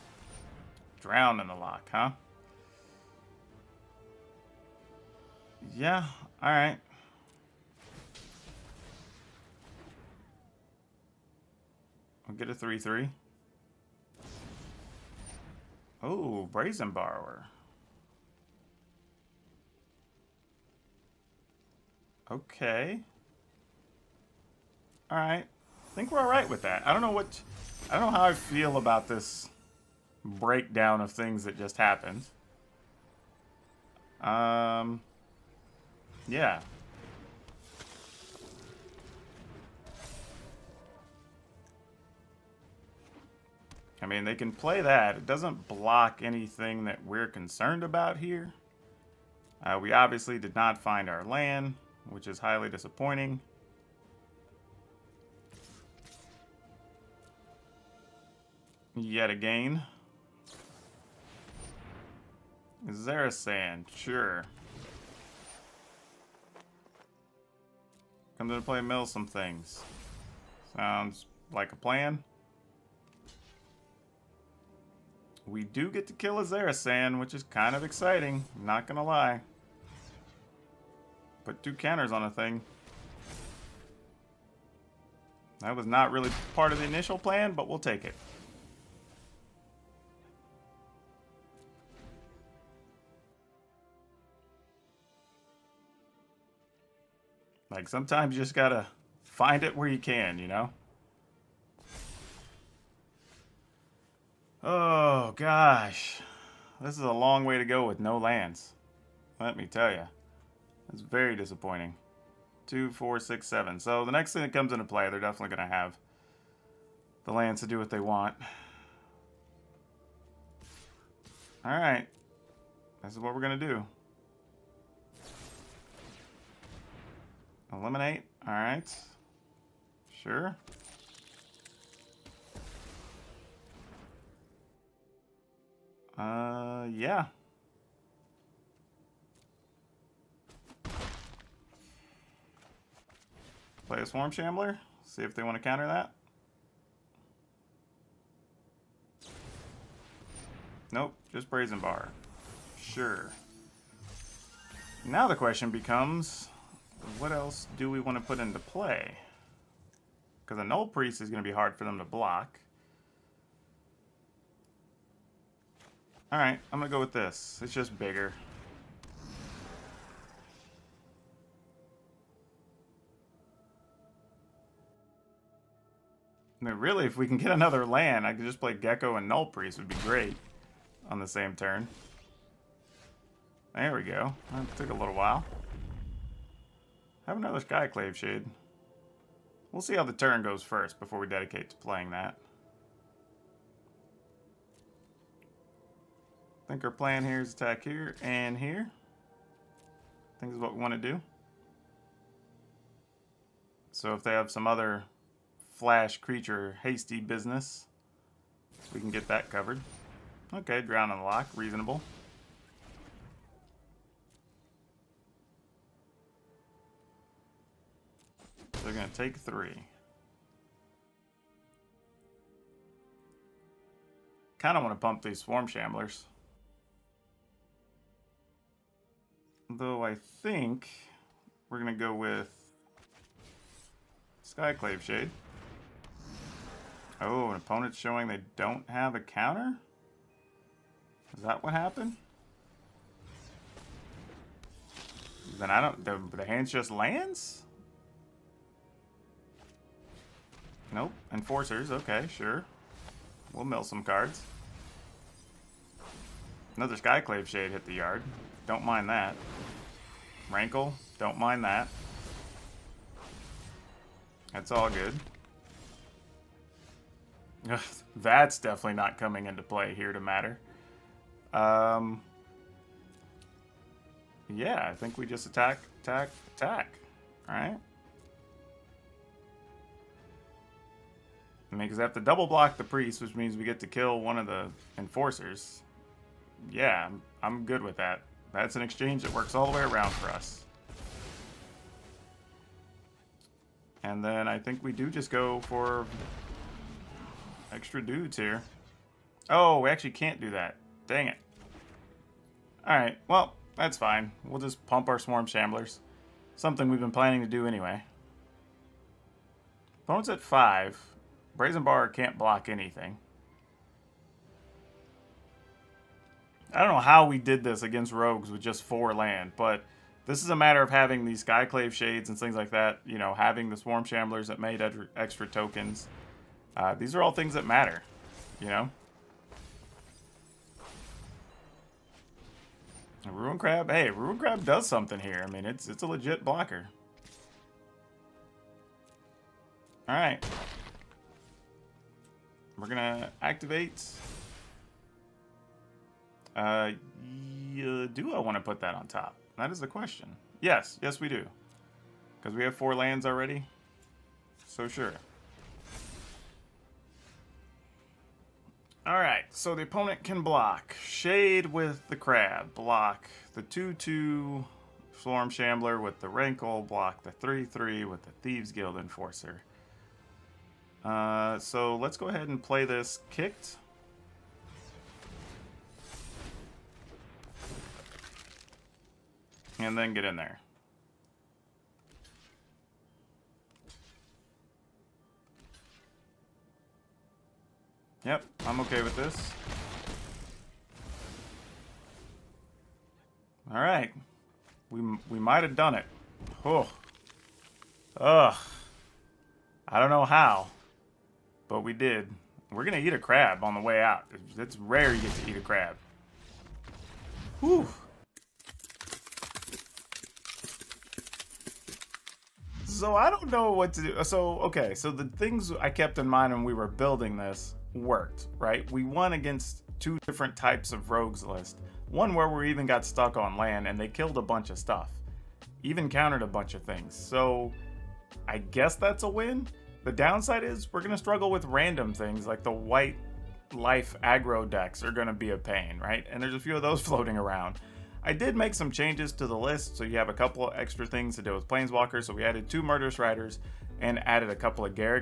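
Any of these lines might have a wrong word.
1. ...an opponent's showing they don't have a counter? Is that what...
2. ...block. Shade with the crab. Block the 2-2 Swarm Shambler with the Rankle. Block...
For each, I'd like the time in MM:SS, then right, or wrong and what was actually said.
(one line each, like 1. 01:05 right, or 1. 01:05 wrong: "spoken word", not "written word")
1. 03:57 right
2. 06:00 right.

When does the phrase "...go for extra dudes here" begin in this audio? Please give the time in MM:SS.
04:55.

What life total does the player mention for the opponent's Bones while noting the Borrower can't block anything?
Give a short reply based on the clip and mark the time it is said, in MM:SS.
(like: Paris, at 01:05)
5, at 05:10.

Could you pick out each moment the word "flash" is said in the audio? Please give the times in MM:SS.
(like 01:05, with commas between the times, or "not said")
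03:25.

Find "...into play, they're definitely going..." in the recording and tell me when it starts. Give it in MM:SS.
01:54.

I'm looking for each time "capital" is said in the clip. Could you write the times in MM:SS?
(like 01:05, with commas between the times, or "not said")
not said.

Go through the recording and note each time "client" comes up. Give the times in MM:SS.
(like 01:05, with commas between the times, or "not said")
not said.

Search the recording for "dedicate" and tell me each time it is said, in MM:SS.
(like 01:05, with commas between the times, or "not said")
03:11.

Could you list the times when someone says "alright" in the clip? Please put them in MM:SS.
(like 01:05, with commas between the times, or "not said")
00:06, 02:46, 05:02, 05:59.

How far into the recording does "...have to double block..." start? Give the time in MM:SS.
04:42.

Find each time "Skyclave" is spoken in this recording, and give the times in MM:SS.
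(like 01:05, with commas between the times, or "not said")
03:07, 03:54, 04:16, 05:21.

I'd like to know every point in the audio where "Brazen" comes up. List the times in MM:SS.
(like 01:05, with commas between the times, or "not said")
00:16, 02:31, 05:11.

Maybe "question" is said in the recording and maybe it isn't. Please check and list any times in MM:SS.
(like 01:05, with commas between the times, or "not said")
02:35, 05:49.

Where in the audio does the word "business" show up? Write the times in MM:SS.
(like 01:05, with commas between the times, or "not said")
03:27.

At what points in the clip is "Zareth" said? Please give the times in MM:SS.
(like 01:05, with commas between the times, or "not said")
01:02, 01:16.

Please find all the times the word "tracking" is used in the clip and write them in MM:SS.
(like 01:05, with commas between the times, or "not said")
not said.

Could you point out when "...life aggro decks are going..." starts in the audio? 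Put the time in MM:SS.
07:13.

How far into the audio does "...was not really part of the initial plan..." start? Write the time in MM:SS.
01:25.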